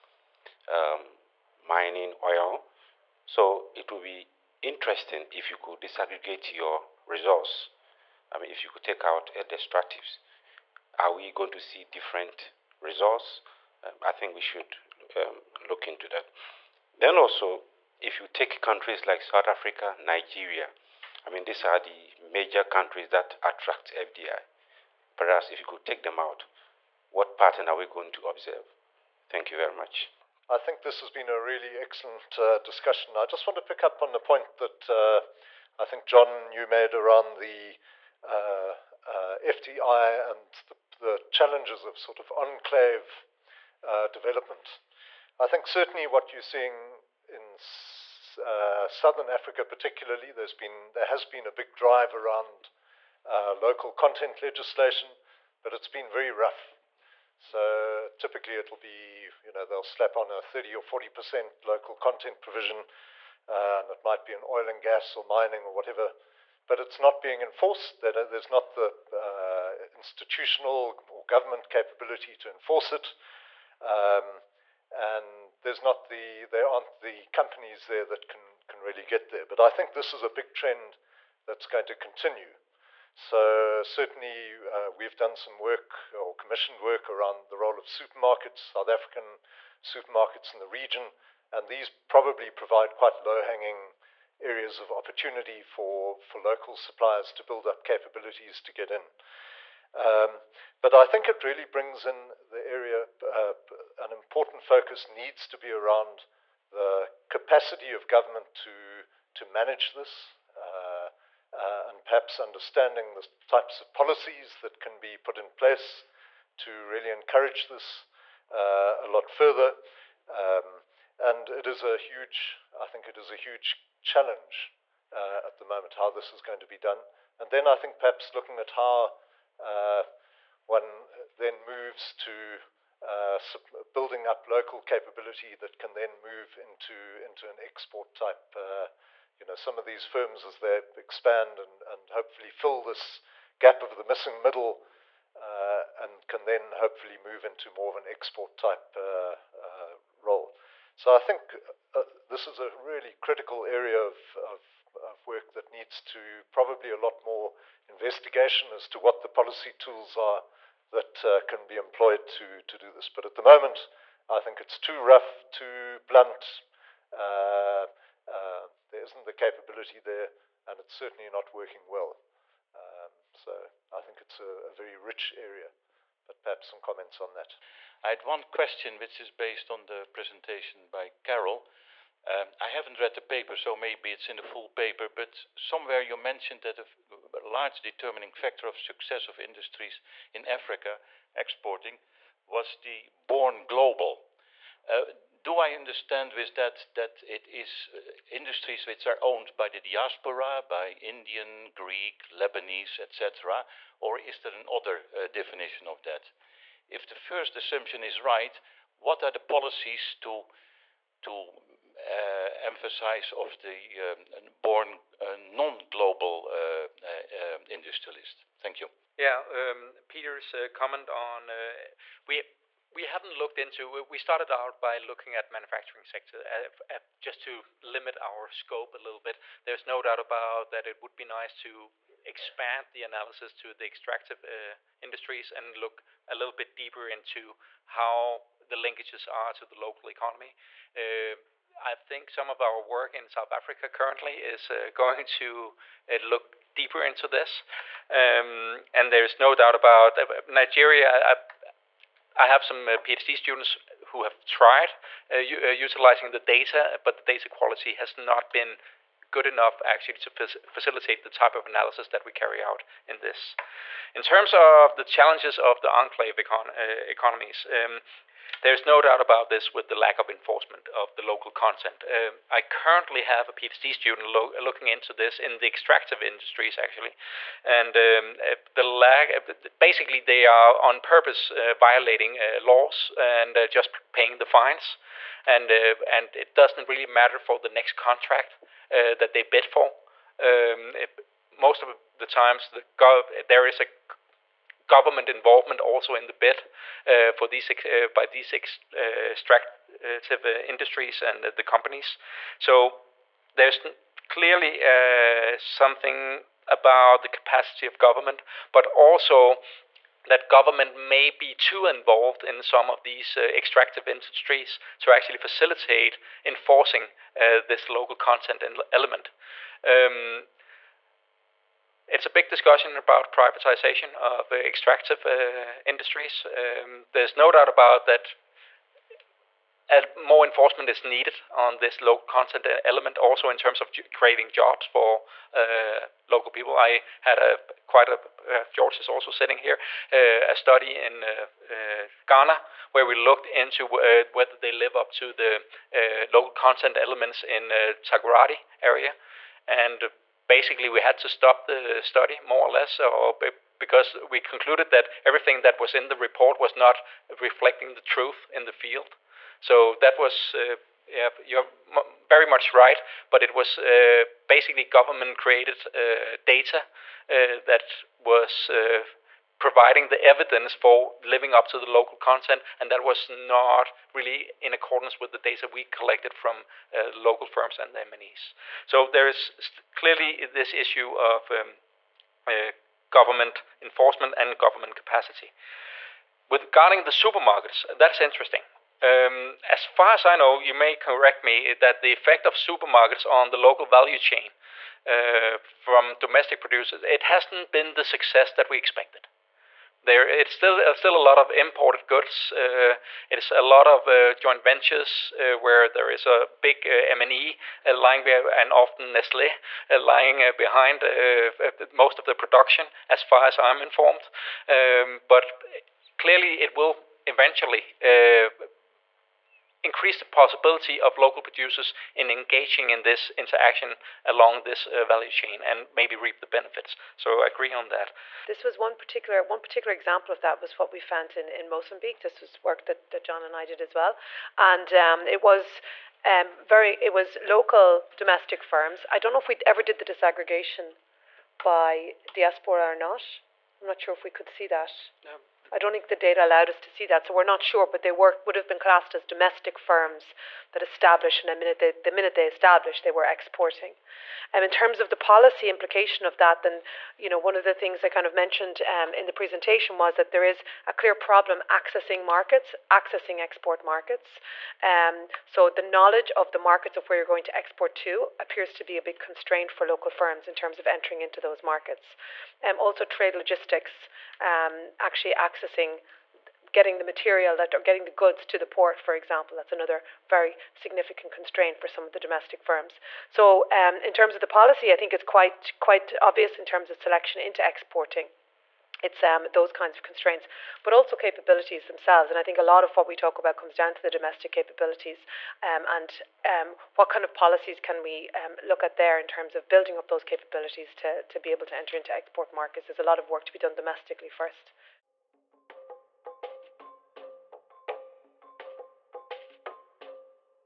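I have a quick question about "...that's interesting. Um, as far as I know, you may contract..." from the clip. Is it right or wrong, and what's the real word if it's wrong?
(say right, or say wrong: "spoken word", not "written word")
wrong: "correct", not "contract".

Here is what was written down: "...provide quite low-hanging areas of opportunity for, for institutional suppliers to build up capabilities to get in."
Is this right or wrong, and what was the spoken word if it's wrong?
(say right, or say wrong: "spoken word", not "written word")
wrong: "local", not "institutional".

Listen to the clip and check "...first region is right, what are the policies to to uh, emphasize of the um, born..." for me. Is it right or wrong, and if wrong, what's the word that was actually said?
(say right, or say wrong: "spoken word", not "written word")
wrong: "assumption", not "region".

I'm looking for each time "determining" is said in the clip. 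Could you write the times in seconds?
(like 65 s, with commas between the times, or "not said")
187 s.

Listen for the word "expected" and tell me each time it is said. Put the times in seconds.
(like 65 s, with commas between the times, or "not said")
398 s.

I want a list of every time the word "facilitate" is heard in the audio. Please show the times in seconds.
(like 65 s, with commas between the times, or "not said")
260 s, 315 s.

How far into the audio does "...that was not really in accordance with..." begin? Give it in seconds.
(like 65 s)
372 s.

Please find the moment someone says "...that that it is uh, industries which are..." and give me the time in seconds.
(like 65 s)
196 s.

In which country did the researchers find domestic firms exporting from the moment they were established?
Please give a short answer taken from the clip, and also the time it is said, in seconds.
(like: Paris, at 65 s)
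Mozambique, at 431 s.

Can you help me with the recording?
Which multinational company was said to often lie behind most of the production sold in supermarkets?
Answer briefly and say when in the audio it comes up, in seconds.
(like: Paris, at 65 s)
Nestlé, at 409 s.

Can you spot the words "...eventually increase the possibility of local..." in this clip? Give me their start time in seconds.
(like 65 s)
417 s.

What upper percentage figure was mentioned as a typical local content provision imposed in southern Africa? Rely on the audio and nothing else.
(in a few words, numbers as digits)
40 percent.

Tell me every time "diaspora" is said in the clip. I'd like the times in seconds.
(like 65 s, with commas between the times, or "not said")
199 s, 442 s.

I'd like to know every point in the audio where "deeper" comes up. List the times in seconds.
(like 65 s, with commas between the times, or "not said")
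236 s, 246 s.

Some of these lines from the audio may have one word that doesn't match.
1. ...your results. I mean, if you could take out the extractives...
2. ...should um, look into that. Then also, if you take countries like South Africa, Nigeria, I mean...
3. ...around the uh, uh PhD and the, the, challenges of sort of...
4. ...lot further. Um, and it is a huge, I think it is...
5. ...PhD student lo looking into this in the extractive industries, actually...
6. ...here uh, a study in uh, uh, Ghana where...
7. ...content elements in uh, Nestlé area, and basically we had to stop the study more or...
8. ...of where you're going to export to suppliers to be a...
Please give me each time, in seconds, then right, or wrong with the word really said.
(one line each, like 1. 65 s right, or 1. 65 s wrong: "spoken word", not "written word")
1. 6 s right
2. 14 s right
3. 36 s wrong: "FDI", not "PhD"
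4. 119 s right
5. 273 s right
6. 339 s right
7. 346 s wrong: "Takoradi", not "Nestlé"
8. 466 s wrong: "appears", not "suppliers".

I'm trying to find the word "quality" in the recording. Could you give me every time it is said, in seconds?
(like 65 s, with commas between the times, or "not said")
257 s.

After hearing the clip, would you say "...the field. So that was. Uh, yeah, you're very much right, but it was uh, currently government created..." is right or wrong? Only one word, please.
wrong.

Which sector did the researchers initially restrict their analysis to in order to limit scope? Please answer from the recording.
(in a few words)
Manufacturing.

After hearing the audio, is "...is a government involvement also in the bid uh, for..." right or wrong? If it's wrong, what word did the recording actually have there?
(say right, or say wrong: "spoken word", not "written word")
right.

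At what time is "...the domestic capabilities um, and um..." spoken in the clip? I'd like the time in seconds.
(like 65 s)
494 s.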